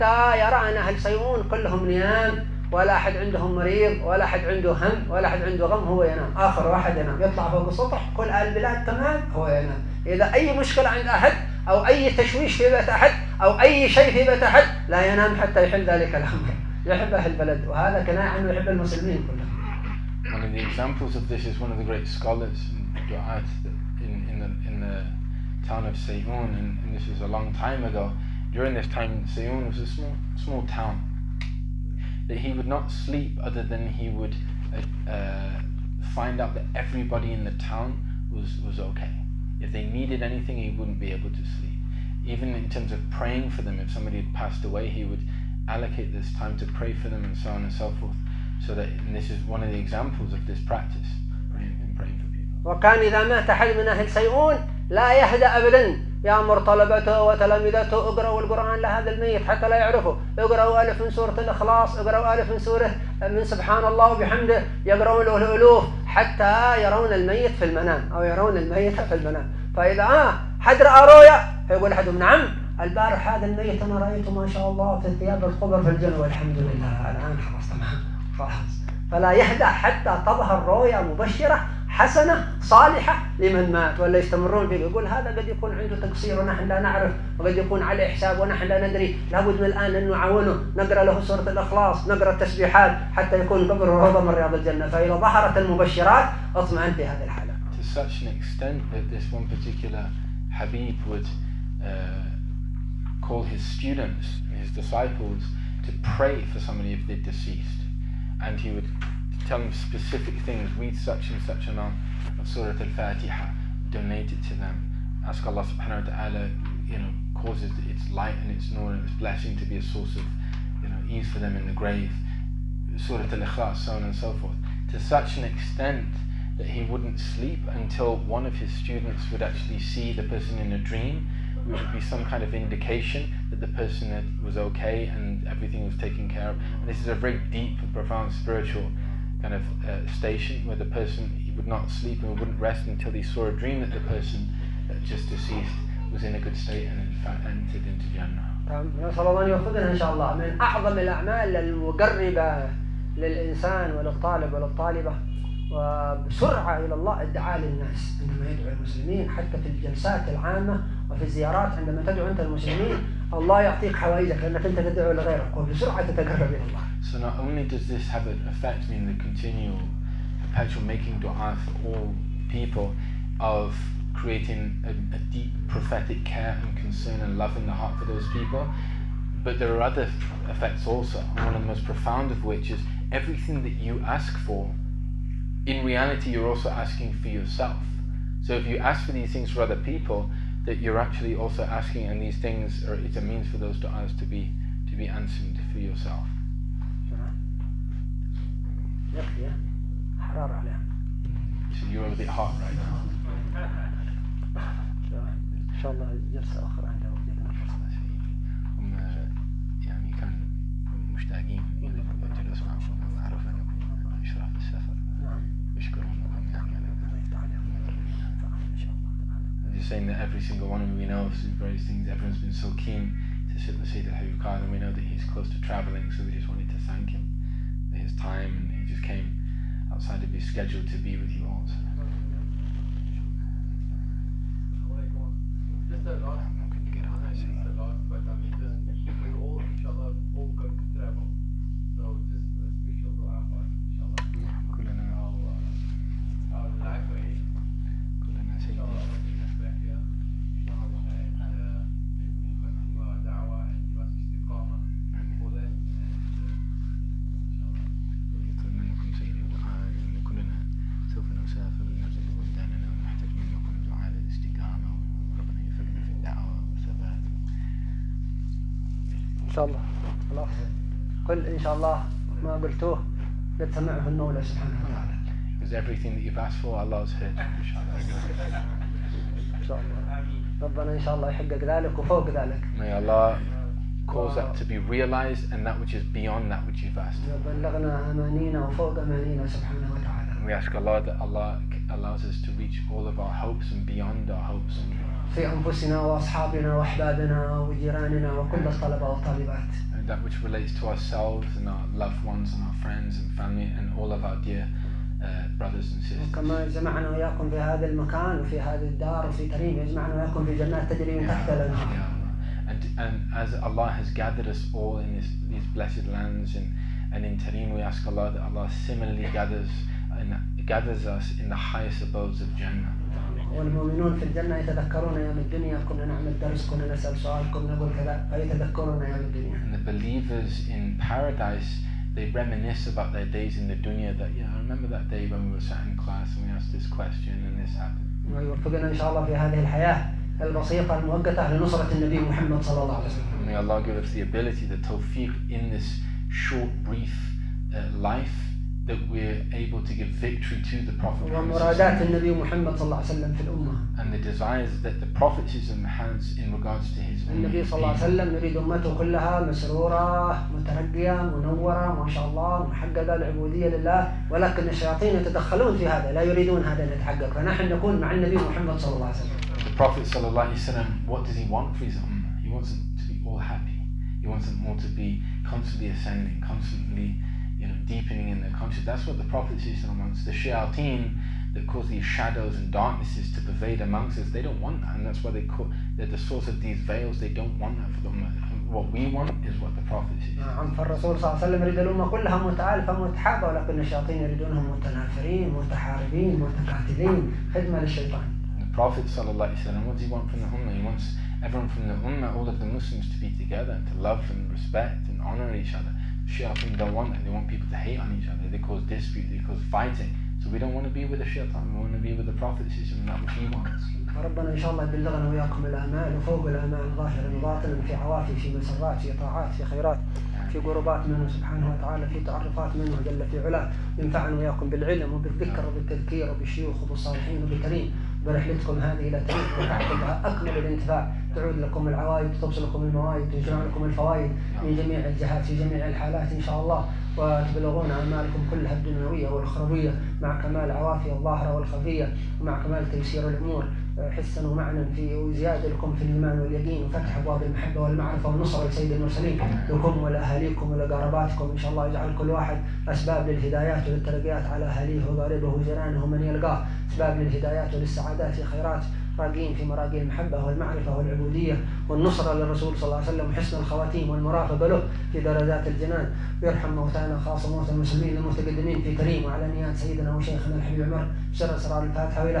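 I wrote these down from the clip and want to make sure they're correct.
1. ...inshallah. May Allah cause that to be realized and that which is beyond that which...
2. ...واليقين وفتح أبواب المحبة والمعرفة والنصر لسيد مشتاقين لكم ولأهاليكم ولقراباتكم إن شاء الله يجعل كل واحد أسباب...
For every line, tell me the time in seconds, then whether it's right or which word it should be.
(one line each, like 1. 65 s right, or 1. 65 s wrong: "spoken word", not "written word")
1. 280 s right
2. 446 s wrong: "المرسلين", not "مشتاقين".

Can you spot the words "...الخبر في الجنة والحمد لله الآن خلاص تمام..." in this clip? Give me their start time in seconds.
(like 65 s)
75 s.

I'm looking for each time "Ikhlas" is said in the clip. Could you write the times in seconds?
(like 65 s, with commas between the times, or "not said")
123 s.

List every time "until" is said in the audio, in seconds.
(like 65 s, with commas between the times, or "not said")
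127 s, 142 s.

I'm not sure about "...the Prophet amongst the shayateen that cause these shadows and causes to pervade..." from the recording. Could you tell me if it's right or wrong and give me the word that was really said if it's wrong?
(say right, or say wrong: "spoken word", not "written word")
wrong: "darknesses", not "causes".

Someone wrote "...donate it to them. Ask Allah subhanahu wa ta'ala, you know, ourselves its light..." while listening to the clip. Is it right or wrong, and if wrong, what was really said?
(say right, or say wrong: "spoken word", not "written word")
wrong: "causes", not "ourselves".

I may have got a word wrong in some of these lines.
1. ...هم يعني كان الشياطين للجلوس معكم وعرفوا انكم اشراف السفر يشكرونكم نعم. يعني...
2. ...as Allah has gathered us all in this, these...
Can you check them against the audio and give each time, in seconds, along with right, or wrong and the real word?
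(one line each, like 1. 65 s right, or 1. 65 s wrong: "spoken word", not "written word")
1. 208 s wrong: "مشتاقين", not "الشياطين"
2. 313 s right.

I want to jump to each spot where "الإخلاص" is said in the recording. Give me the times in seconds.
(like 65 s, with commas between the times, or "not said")
61 s, 91 s.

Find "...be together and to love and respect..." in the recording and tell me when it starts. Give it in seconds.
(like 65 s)
403 s.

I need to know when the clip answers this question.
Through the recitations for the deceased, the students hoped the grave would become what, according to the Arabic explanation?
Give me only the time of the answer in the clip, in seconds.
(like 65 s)
93 s.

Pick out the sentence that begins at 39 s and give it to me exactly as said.
If they needed anything, he wouldn't be able to sleep.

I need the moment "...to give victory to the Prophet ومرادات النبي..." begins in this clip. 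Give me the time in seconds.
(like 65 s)
349 s.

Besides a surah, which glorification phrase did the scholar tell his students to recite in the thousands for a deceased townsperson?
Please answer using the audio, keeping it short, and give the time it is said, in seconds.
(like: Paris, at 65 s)
سبحان الله وبحمده, at 63 s.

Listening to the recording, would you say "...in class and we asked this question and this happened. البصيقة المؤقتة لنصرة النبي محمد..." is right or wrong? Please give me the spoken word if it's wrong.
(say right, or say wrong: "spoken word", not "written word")
right.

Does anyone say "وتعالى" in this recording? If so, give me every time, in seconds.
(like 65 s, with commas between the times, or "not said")
274 s, 421 s.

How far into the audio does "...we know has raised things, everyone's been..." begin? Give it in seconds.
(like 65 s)
220 s.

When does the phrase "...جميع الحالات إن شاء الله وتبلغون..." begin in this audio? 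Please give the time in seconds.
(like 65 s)
435 s.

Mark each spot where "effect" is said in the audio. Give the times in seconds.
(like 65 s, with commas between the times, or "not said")
168 s, 180 s.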